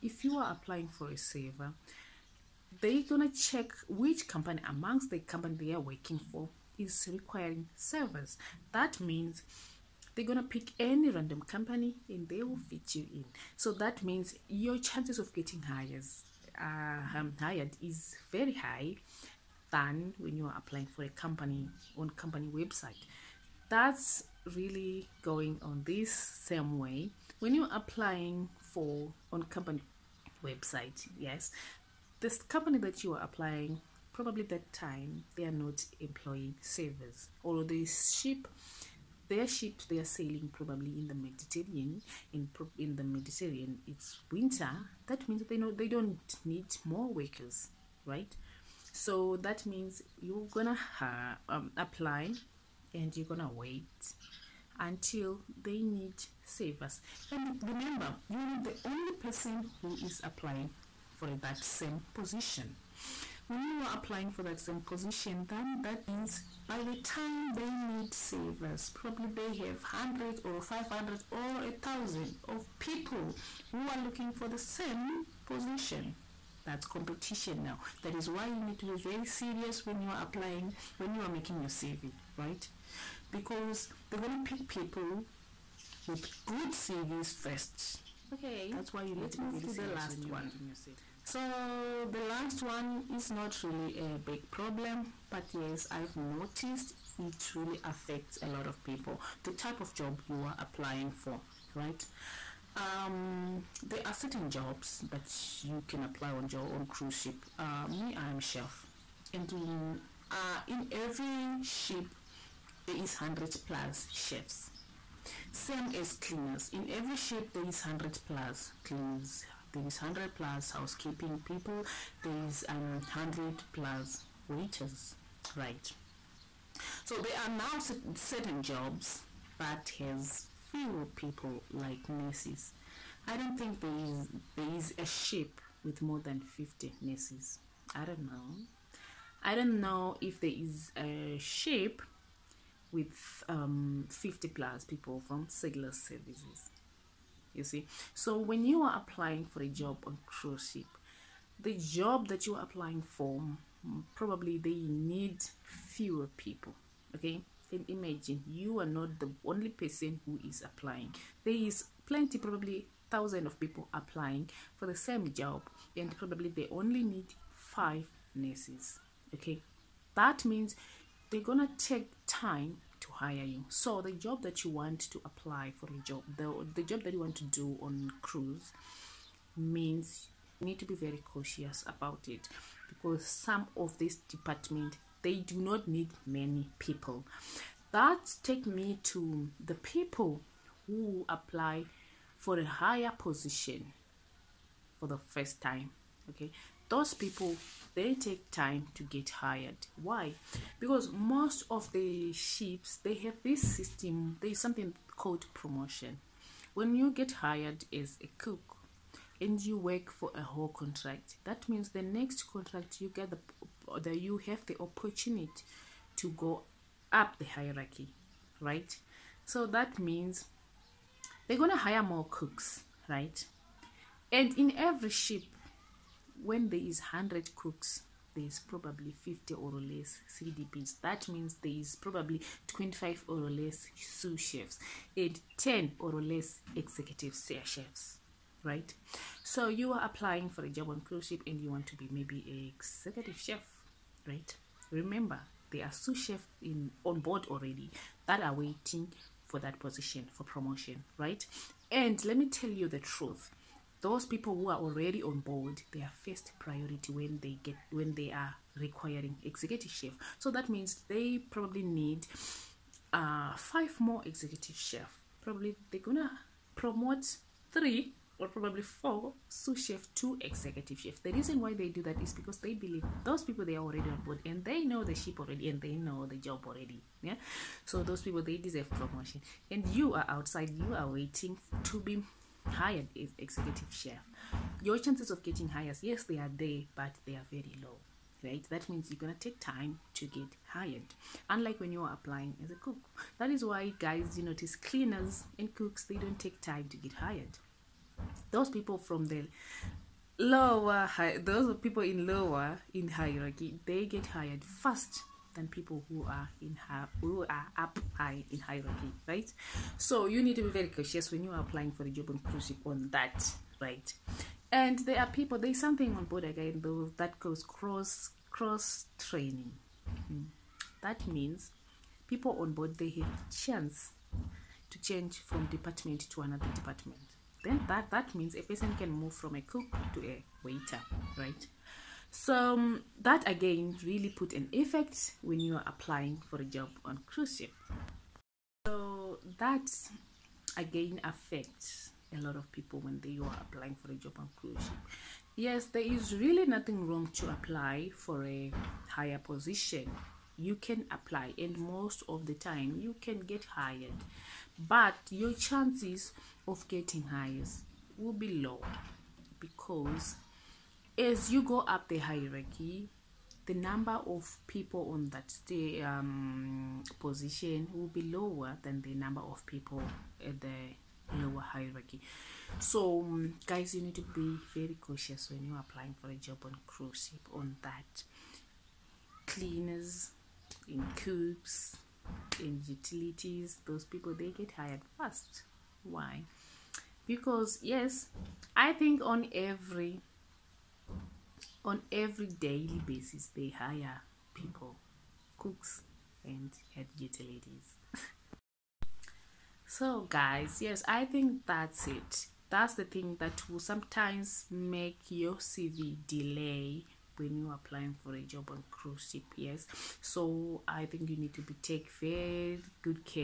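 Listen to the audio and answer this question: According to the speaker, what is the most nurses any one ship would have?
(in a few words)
50.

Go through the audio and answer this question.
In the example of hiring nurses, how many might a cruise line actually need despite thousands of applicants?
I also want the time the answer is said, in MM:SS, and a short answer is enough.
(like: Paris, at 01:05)
5, at 02:47.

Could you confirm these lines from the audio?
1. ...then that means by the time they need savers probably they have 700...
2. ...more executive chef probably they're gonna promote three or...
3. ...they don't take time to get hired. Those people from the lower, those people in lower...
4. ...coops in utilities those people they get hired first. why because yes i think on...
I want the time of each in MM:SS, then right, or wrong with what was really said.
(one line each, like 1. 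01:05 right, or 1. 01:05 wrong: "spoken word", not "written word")
1. 01:05 wrong: "100", not "700"
2. 04:23 right
3. 04:56 right
4. 06:21 right.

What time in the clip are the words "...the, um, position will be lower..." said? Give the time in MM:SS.
06:05.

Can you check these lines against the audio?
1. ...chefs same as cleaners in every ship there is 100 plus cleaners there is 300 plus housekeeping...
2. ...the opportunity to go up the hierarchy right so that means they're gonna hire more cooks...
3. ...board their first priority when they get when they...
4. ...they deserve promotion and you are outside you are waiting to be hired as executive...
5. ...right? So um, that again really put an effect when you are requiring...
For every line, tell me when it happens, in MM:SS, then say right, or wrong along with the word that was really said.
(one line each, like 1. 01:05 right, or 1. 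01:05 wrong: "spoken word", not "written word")
1. 01:54 wrong: "100", not "300"
2. 03:34 right
3. 04:15 right
4. 04:38 right
5. 05:31 wrong: "applying", not "requiring".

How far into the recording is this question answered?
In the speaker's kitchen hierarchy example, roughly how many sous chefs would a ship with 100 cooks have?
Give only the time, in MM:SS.
03:52.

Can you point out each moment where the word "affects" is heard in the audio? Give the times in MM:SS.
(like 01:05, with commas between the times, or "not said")
01:37, 05:41.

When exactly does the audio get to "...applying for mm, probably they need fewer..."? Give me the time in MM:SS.
02:32.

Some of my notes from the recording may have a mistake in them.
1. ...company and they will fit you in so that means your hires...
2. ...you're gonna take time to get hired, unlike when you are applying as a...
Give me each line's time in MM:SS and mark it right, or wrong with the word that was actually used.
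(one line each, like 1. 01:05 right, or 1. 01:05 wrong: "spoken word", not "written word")
1. 00:11 wrong: "chances", not "hires"
2. 04:49 right.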